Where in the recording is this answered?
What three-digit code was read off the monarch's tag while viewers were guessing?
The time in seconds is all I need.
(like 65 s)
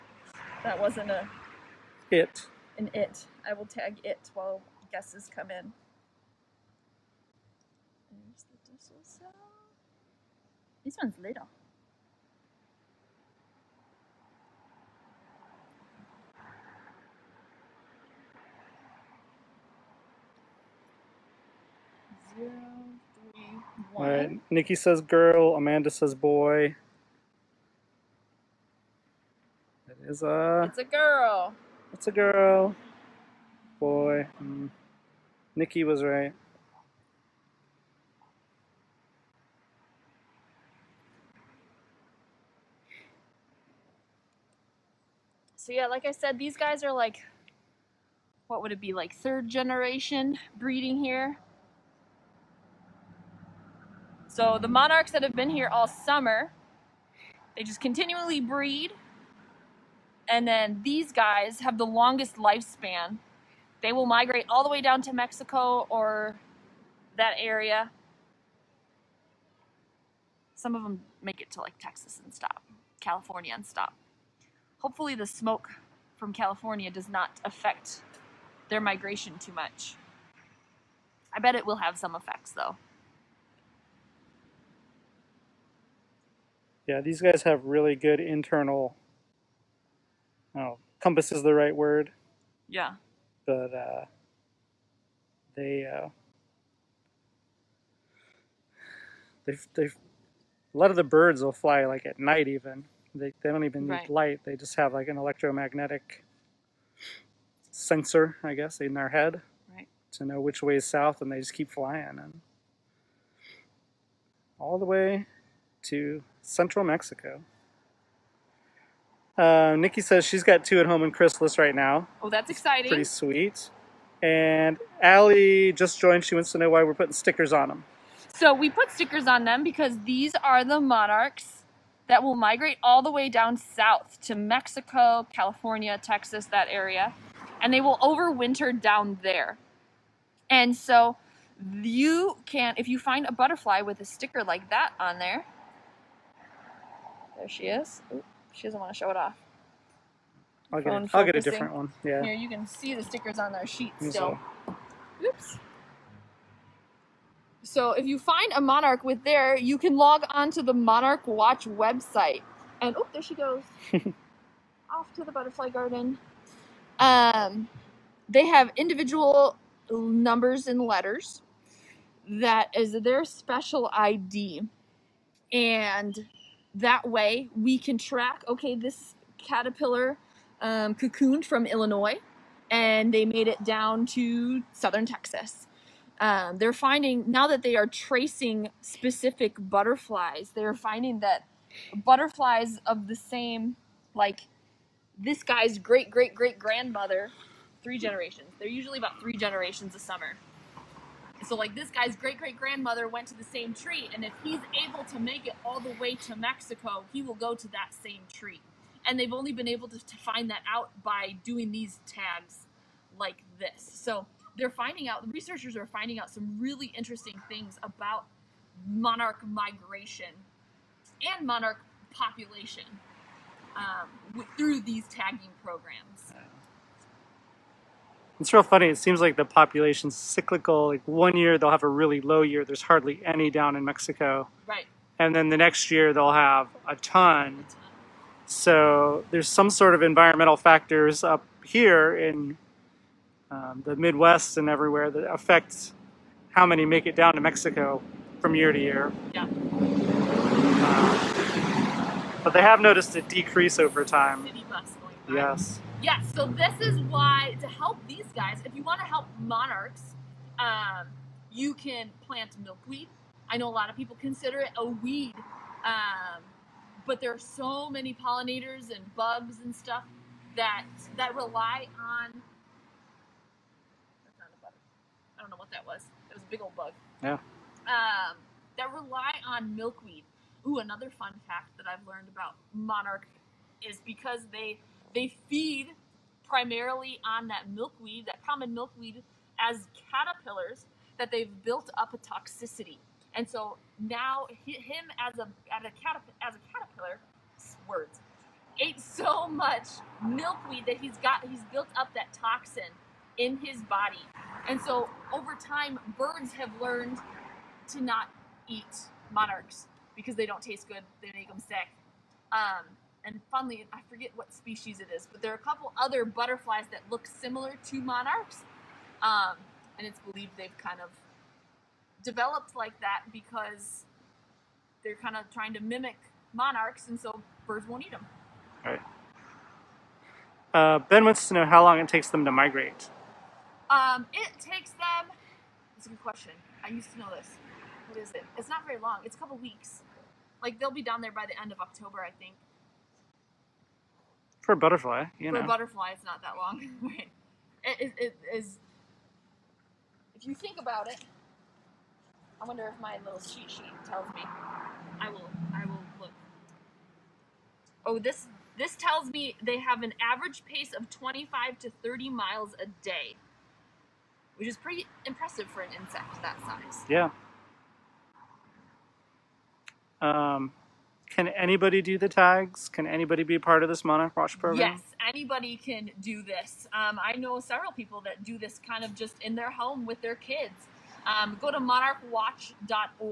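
22 s.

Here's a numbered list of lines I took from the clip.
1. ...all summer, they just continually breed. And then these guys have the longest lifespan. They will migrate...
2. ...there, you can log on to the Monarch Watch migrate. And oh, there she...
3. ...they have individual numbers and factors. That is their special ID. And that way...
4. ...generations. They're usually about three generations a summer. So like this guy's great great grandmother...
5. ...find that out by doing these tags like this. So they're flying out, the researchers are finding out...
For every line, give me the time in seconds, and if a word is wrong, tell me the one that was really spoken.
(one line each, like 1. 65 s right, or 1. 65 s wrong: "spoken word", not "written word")
1. 55 s right
2. 159 s wrong: "website", not "migrate"
3. 168 s wrong: "letters", not "factors"
4. 197 s right
5. 210 s wrong: "finding", not "flying".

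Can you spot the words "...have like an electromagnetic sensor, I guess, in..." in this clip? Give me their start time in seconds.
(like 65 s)
104 s.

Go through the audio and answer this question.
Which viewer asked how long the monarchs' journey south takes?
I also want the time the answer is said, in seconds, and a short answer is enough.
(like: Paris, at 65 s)
Ben, at 330 s.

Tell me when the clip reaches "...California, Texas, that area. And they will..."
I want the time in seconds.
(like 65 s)
135 s.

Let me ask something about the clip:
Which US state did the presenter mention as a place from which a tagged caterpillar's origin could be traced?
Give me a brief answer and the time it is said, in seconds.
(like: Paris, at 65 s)
Illinois, at 181 s.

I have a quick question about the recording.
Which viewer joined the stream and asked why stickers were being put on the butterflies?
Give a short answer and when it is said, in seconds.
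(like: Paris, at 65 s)
Allie, at 125 s.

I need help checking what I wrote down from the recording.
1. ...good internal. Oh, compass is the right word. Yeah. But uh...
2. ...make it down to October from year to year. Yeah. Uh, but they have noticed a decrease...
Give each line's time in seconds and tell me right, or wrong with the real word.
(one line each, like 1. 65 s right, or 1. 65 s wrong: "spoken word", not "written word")
1. 87 s right
2. 246 s wrong: "Mexico", not "October".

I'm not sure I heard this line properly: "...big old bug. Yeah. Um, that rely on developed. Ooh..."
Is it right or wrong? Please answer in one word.
wrong.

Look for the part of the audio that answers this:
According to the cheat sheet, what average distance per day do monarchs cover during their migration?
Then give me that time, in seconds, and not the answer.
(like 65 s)
361 s.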